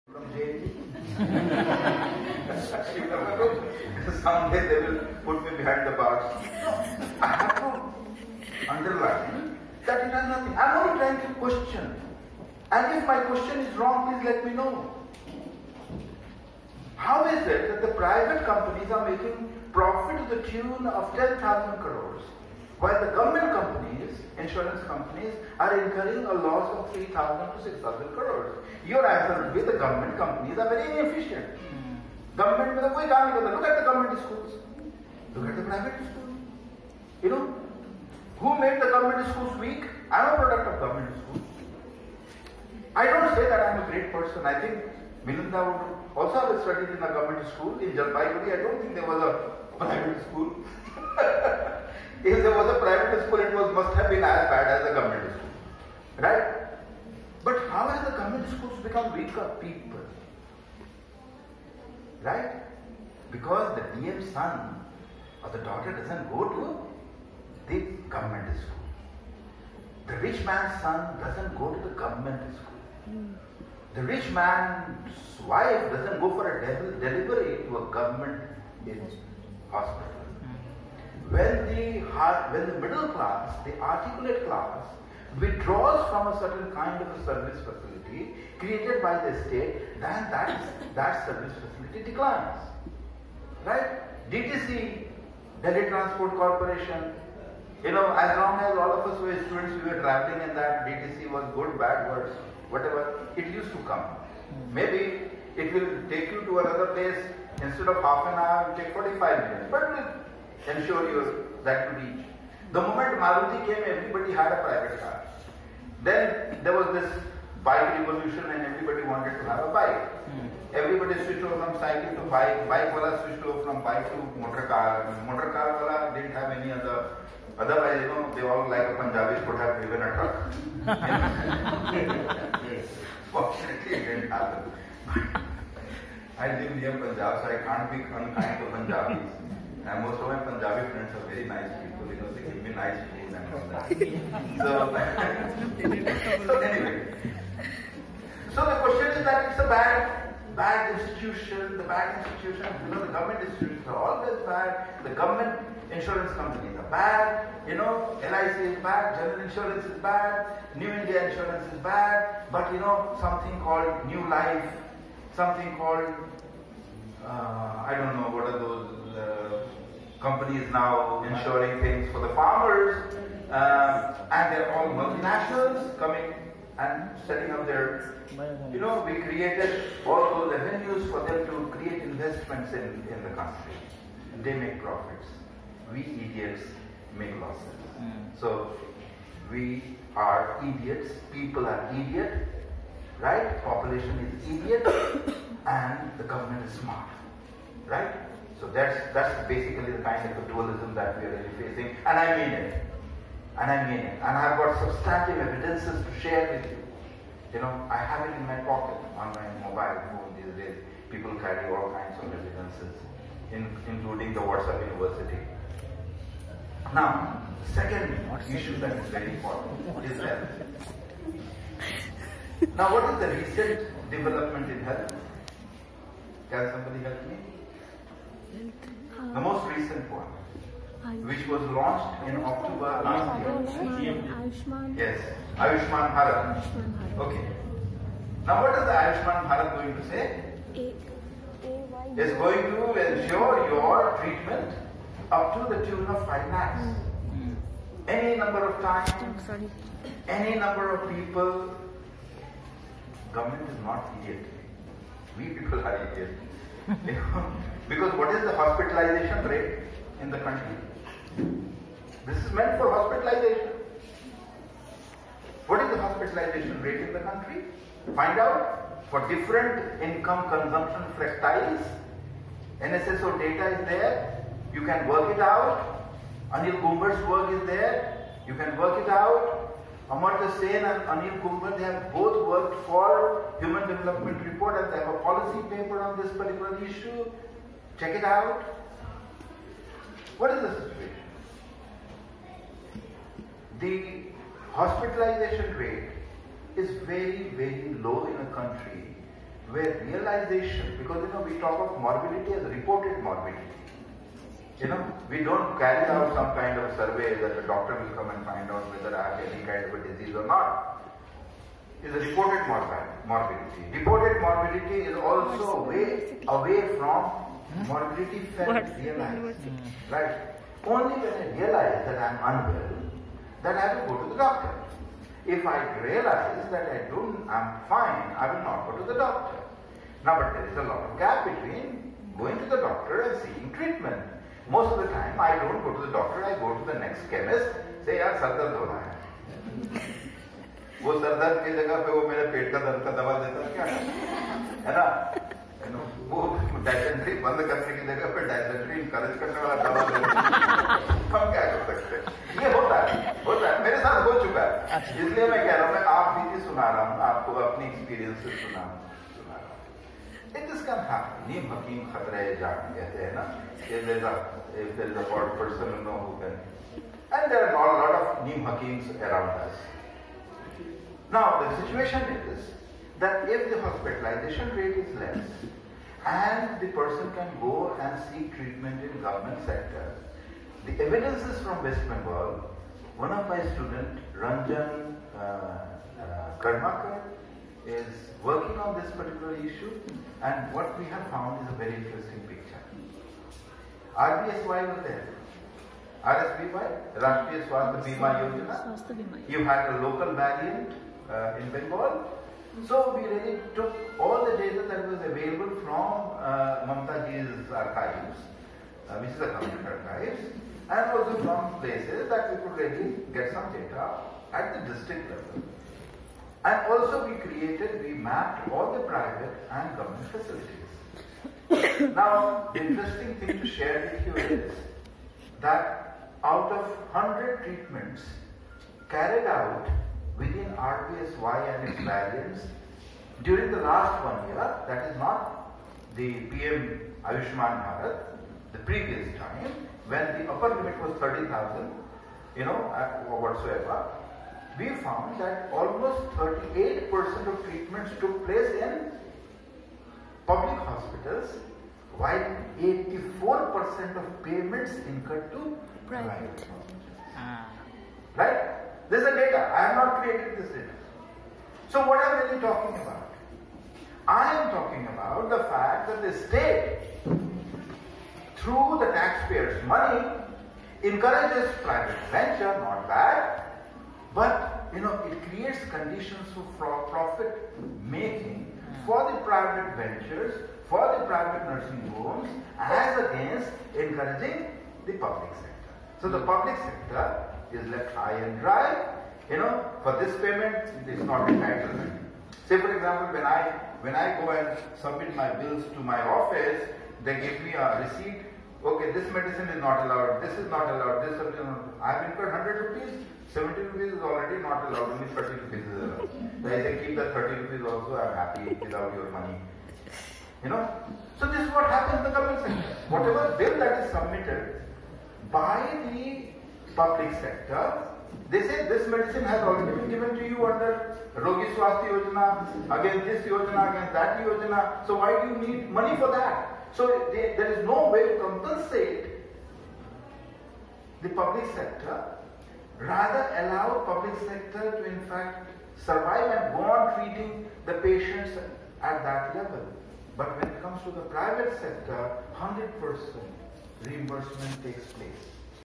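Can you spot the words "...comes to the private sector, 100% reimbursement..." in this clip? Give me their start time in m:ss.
9:00.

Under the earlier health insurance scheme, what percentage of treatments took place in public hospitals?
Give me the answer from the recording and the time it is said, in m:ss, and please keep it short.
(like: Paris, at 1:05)
38%, at 7:26.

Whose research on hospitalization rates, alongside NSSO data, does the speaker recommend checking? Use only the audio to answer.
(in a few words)
Anil Gumber.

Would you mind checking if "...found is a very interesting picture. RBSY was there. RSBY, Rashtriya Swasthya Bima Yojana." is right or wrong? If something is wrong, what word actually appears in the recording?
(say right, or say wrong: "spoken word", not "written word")
right.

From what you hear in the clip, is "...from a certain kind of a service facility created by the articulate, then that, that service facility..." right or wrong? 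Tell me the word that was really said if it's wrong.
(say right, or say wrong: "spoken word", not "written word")
wrong: "state", not "articulate".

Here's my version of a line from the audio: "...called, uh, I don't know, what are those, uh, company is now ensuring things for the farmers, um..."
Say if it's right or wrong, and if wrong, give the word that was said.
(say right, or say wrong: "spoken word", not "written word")
right.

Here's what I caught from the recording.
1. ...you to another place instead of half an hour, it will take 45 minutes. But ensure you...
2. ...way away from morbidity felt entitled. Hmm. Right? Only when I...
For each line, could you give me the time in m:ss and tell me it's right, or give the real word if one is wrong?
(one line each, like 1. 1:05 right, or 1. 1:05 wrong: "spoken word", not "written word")
1. 1:46 right
2. 5:15 wrong: "realized", not "entitled".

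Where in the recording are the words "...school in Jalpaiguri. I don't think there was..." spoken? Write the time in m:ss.
0:47.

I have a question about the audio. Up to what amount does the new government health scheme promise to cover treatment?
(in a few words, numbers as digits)
5 lakhs.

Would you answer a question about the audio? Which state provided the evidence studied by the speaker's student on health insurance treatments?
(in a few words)
West Bengal.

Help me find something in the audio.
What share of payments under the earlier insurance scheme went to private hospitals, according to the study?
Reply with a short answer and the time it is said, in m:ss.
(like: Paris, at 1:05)
84%, at 7:32.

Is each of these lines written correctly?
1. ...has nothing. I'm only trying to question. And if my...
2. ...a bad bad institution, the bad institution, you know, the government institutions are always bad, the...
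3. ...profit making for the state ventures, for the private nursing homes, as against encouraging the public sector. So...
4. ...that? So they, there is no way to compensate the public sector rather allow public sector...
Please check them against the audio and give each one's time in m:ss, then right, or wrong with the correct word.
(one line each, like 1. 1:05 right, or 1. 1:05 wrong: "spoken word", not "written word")
1. 0:10 right
2. 2:29 right
3. 7:57 wrong: "private", not "state"
4. 8:46 right.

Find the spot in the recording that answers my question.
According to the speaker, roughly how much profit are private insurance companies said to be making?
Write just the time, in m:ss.
0:21.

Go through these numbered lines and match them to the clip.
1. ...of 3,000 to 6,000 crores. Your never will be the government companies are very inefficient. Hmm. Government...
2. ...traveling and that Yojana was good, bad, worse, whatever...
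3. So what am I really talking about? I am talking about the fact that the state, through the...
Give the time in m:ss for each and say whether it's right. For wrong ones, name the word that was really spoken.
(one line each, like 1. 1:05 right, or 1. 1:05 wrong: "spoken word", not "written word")
1. 0:26 wrong: "answer", not "never"
2. 1:40 wrong: "DTC", not "Yojana"
3. 7:41 right.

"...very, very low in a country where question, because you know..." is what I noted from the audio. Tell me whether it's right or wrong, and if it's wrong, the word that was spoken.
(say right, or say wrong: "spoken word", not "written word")
wrong: "realization", not "question".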